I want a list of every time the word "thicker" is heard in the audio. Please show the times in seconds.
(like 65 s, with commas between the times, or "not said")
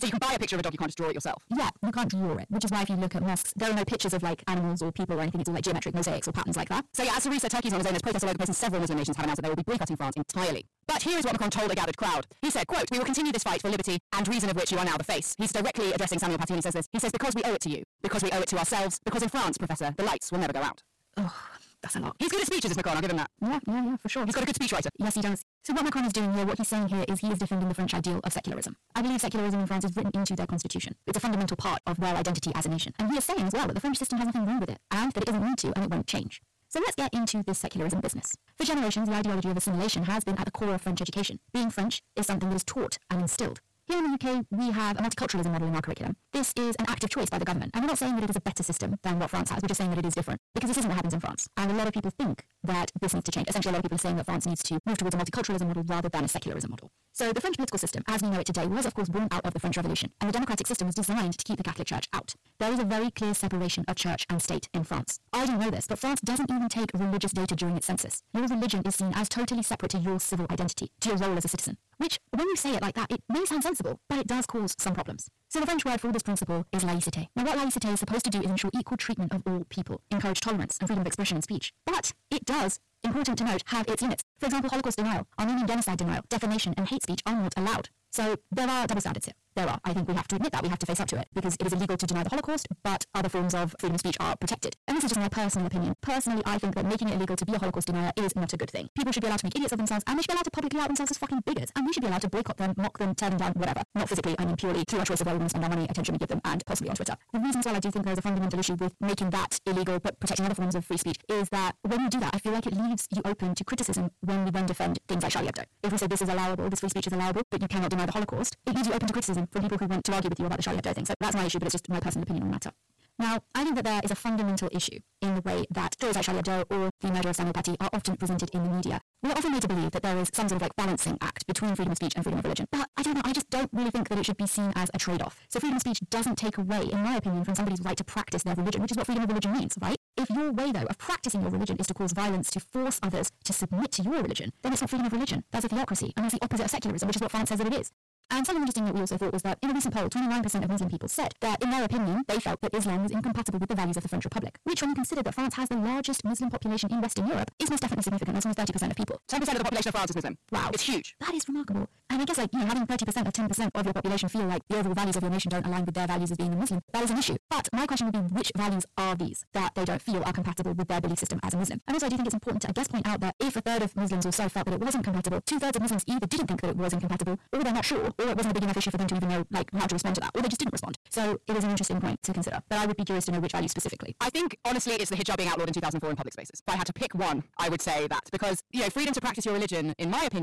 not said.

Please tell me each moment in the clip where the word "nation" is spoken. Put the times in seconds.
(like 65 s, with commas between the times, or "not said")
8 s, 32 s, 165 s.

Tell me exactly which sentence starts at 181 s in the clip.
So it is an interesting point to consider.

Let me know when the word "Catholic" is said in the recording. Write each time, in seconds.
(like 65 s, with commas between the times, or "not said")
61 s.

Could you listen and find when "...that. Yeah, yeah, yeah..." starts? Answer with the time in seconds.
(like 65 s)
23 s.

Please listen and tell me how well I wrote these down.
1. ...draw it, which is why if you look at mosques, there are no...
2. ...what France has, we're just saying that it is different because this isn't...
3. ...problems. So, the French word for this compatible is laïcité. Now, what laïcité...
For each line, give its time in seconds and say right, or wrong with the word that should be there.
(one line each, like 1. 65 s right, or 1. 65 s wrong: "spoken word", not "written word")
1. 2 s right
2. 49 s right
3. 74 s wrong: "principle", not "compatible".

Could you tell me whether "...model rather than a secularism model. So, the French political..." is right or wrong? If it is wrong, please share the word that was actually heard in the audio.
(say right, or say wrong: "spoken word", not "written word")
right.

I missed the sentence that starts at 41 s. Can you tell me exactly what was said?
Being French is something that is taught and instilled.